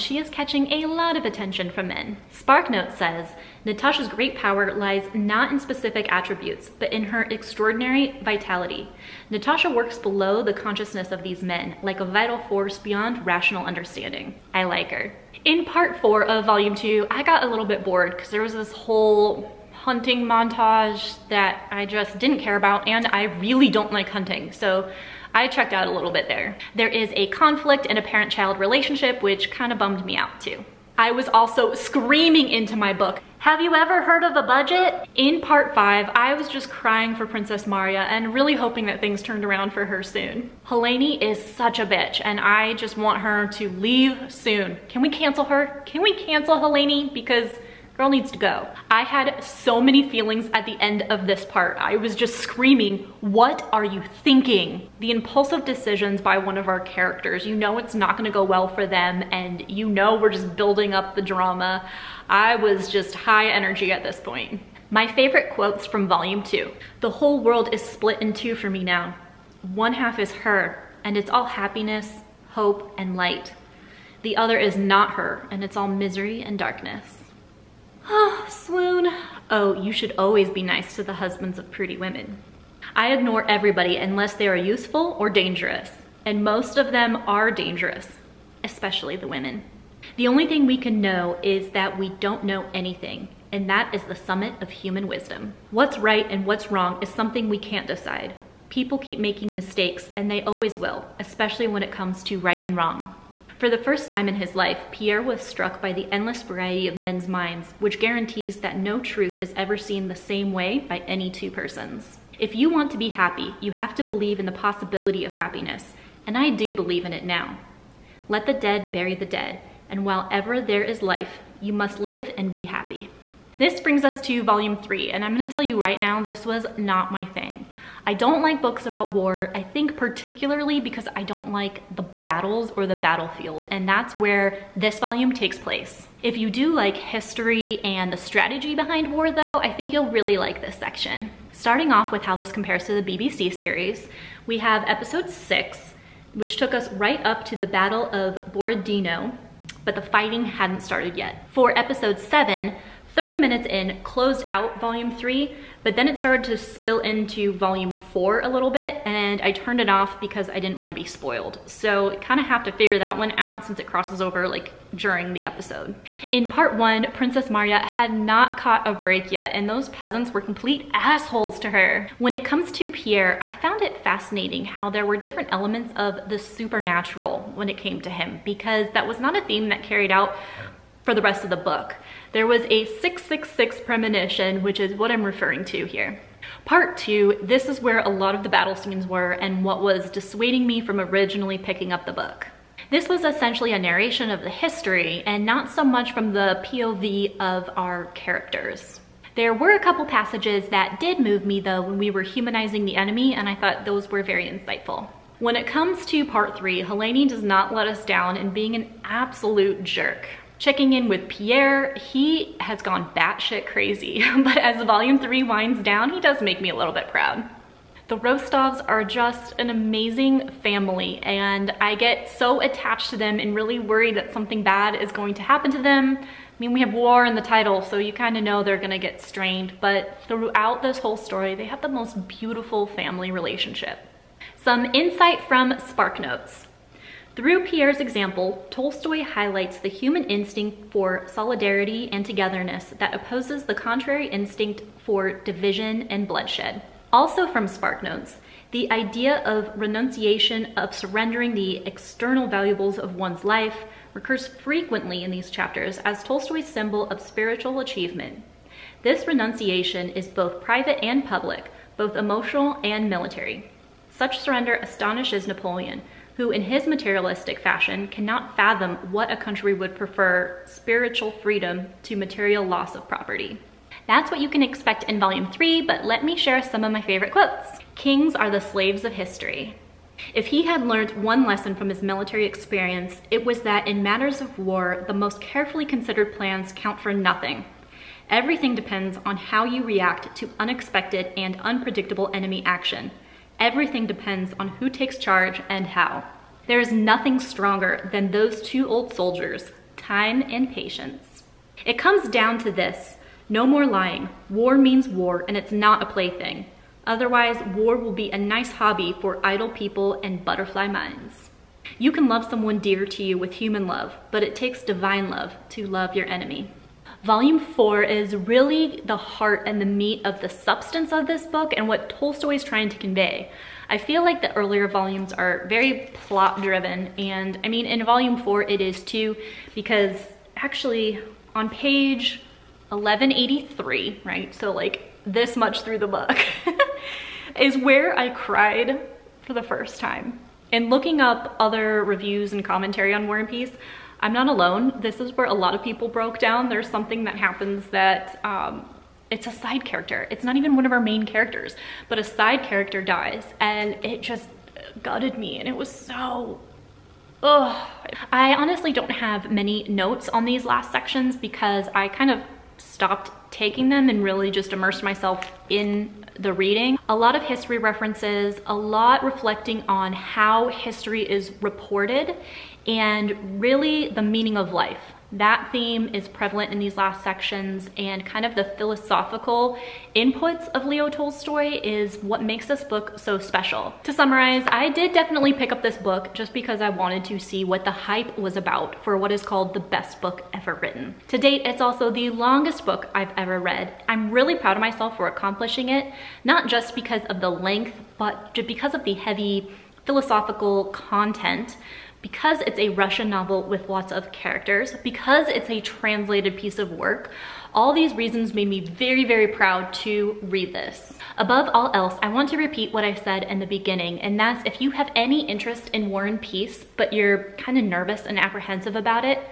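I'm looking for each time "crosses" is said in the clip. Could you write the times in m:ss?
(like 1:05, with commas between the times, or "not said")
2:43.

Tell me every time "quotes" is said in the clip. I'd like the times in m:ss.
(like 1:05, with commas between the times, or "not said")
1:05, 4:37.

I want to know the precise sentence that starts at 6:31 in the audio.
To date, it's also the longest book I've ever read.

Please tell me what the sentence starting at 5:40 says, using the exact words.
And looking up other reviews and commentary on War and Peace, I'm not alone.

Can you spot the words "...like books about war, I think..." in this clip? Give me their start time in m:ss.
2:08.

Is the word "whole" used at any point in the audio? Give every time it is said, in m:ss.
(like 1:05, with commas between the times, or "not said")
0:18, 1:07, 3:50.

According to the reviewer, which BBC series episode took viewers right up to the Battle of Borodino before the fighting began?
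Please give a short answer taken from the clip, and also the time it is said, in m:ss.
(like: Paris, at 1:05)
Episode 6, at 2:24.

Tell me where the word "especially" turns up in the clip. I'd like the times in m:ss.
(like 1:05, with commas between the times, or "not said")
1:28, 1:41.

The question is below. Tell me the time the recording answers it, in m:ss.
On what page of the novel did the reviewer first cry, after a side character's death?
5:32.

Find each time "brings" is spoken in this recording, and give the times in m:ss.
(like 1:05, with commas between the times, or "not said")
2:03.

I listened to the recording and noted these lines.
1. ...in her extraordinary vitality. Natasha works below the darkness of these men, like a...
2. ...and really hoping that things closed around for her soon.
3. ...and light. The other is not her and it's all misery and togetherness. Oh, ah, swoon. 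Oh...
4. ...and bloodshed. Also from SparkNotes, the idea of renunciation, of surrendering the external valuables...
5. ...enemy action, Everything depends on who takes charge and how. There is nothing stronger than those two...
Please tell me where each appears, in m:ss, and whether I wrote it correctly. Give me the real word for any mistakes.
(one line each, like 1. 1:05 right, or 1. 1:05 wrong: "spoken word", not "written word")
1. 0:06 wrong: "consciousness", not "darkness"
2. 0:38 wrong: "turned", not "closed"
3. 1:12 wrong: "darkness", not "togetherness"
4. 4:06 right
5. 4:52 right.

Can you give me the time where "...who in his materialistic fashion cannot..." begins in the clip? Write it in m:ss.
4:26.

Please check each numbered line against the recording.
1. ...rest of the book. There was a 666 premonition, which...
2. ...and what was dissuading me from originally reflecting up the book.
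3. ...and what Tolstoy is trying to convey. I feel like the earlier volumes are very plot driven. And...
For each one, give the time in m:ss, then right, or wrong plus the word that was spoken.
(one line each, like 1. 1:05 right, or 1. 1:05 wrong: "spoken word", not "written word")
1. 3:01 right
2. 3:09 wrong: "picking", not "reflecting"
3. 5:21 right.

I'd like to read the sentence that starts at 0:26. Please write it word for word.
There is a conflict in a parent-child relationship, which kind of bummed me out too.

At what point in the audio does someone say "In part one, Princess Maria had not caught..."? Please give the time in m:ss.
2:46.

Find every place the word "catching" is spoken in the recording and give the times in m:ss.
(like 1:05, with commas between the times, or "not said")
0:00.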